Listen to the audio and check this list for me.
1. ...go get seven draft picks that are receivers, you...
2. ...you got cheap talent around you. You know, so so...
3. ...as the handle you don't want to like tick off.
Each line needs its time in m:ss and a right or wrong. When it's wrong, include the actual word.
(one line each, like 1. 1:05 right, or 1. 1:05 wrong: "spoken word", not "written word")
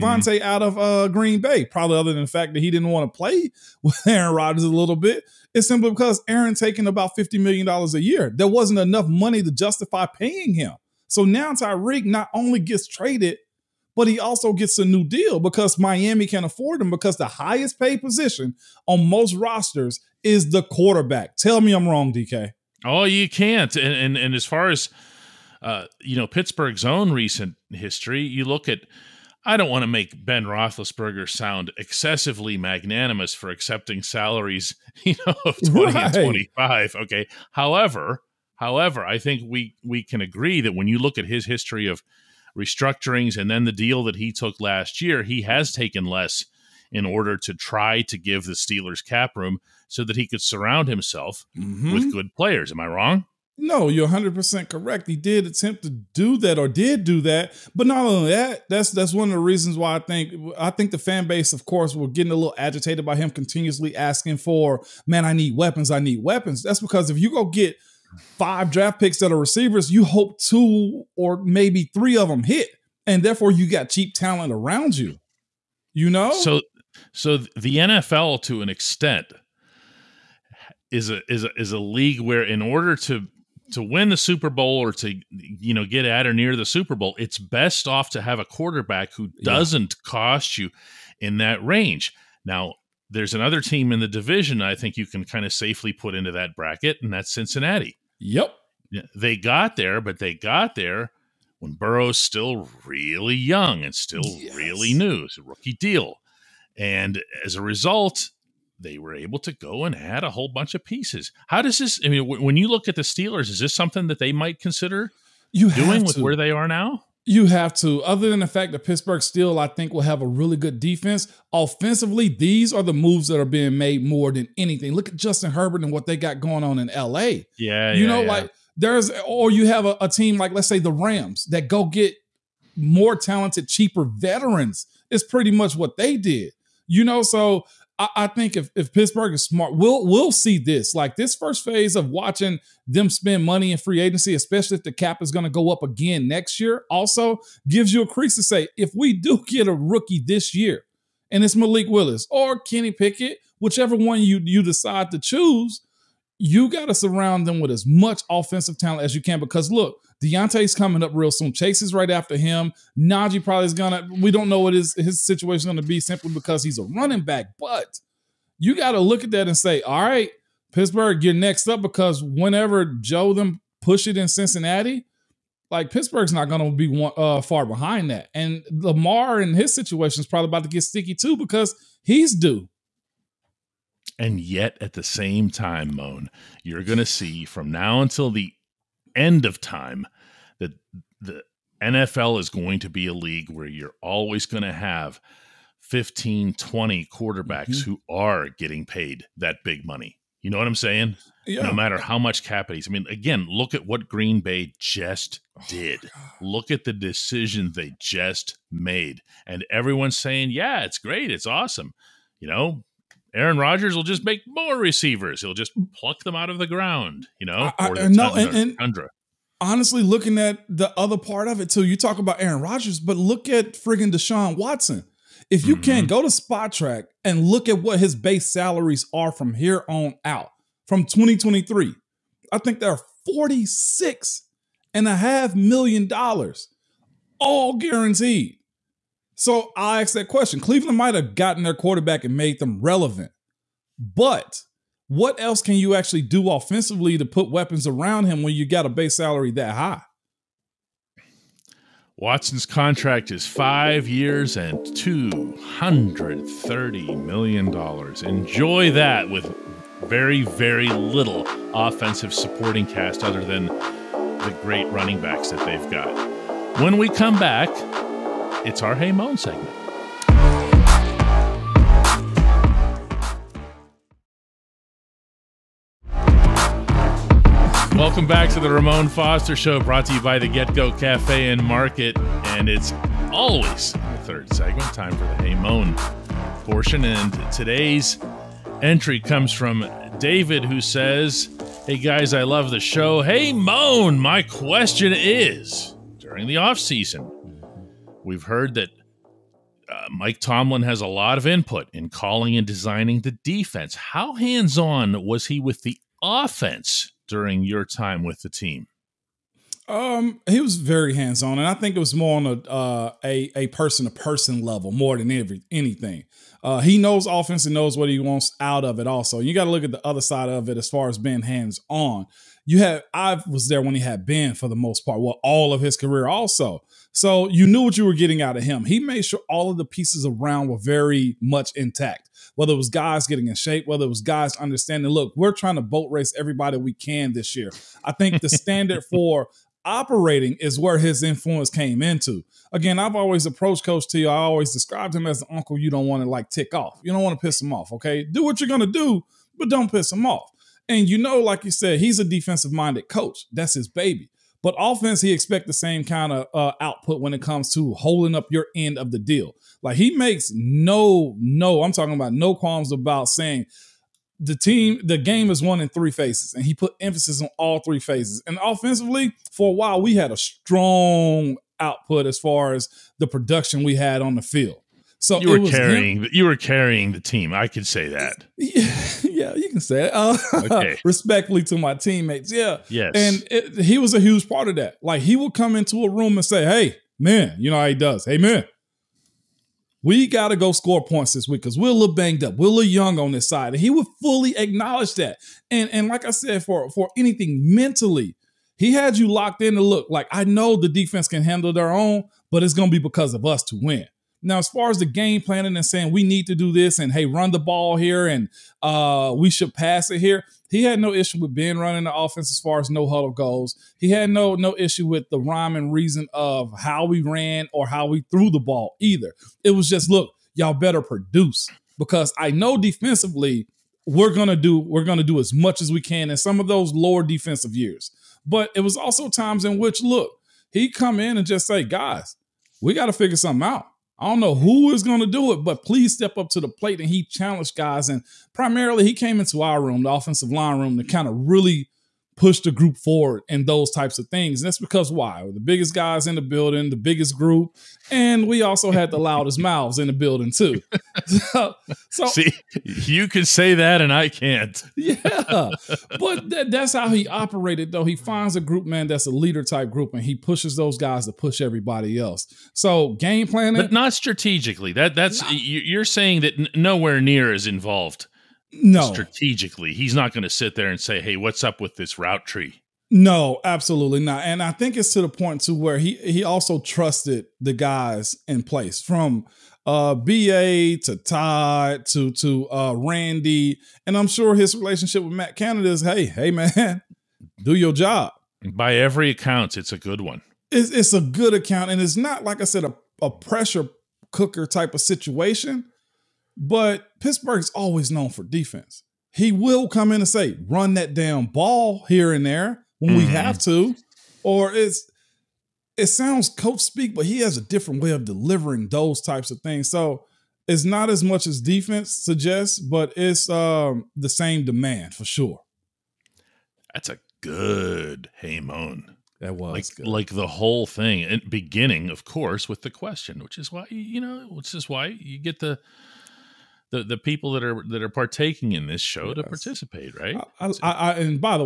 1. 1:07 wrong: "five", not "seven"
2. 1:13 right
3. 5:45 wrong: "uncle", not "handle".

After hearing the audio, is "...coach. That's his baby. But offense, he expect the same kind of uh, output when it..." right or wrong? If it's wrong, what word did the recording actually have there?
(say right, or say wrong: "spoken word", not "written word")
right.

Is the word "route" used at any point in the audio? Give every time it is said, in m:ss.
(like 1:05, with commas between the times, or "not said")
7:52.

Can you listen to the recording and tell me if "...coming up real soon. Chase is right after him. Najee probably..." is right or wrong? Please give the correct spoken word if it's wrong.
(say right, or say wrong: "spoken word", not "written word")
right.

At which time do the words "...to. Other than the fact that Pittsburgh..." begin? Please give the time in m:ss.
1:57.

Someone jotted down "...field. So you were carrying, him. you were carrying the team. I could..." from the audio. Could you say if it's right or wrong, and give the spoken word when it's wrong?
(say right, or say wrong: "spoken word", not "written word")
right.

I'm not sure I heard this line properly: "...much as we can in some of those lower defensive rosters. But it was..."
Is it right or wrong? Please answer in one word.
wrong.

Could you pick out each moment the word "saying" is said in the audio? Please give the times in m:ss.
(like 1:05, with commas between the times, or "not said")
3:20, 3:30, 6:03, 6:45, 7:46.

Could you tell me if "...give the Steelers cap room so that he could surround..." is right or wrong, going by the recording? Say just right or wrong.
right.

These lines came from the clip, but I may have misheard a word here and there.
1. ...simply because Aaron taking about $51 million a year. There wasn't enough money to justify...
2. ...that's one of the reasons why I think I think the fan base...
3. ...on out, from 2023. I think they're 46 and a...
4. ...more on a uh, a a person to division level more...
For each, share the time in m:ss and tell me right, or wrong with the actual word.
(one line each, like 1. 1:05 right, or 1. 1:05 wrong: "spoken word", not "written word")
1. 0:05 wrong: "50", not "51"
2. 0:58 right
3. 3:49 right
4. 5:12 wrong: "person", not "division".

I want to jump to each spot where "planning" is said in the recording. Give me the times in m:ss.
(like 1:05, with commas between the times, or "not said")
6:45, 7:43.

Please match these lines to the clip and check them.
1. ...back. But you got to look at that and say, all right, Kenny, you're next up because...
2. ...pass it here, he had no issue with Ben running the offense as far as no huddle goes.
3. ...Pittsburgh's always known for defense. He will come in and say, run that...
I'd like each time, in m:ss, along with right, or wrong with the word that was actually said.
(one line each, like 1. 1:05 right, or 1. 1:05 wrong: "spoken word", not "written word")
1. 2:47 wrong: "Pittsburgh", not "Kenny"
2. 6:49 right
3. 8:17 right.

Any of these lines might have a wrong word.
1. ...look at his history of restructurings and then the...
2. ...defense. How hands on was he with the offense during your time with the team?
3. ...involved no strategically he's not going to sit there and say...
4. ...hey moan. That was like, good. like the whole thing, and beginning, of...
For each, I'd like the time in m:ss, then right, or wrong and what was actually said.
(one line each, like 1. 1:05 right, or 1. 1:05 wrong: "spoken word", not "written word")
1. 0:40 right
2. 5:03 right
3. 7:47 right
4. 8:38 right.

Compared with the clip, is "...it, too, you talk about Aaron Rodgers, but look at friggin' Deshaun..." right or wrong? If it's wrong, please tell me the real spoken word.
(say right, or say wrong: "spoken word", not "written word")
right.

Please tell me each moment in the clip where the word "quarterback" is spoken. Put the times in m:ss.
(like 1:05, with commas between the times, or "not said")
0:20, 1:28, 3:17, 4:01.